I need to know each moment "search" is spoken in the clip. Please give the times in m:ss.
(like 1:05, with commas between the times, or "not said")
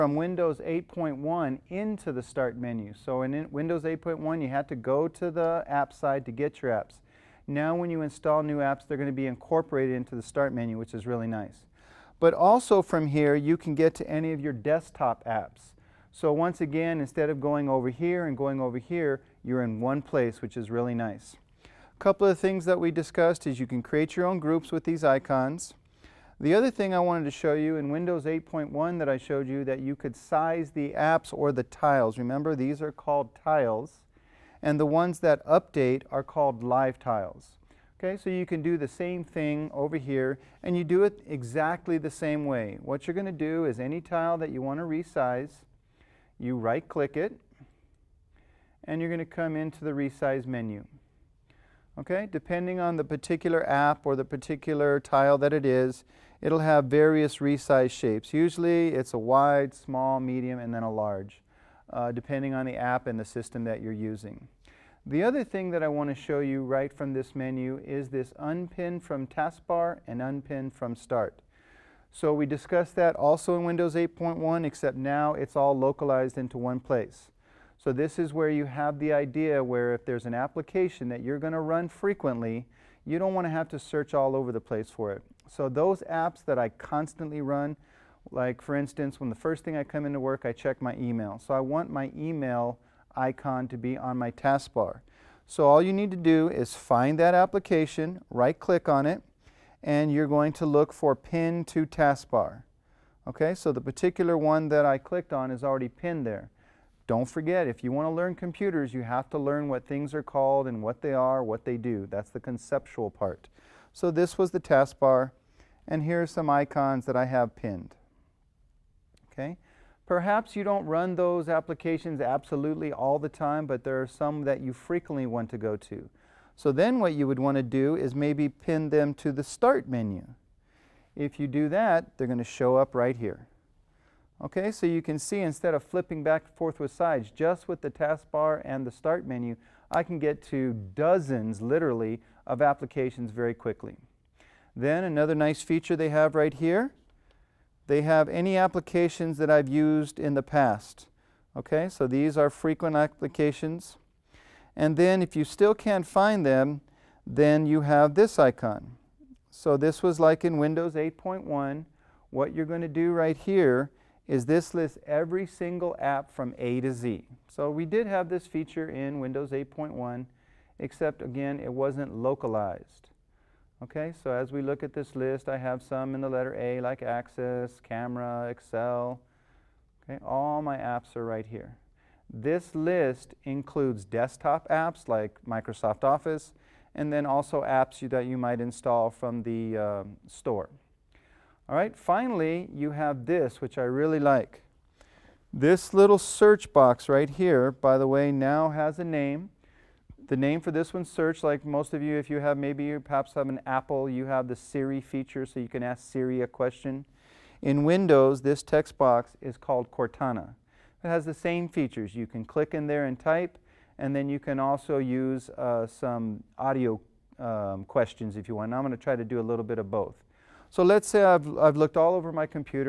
1:23, 3:16, 3:21.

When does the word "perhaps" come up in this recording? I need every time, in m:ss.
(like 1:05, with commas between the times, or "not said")
2:00, 3:22.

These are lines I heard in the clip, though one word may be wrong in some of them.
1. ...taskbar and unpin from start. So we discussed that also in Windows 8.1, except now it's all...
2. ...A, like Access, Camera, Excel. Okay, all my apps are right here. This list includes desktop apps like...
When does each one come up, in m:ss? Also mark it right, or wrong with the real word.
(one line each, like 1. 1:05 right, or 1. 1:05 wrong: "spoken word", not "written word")
1. 1:09 right
2. 2:56 right.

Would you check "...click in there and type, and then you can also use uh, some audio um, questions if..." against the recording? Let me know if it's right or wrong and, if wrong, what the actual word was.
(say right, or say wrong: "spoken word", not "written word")
right.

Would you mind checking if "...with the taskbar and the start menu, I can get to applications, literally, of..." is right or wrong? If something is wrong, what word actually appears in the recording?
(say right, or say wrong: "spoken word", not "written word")
wrong: "dozens", not "applications".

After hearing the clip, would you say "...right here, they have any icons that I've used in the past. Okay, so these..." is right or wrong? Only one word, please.
wrong.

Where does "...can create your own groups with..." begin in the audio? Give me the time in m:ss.
0:23.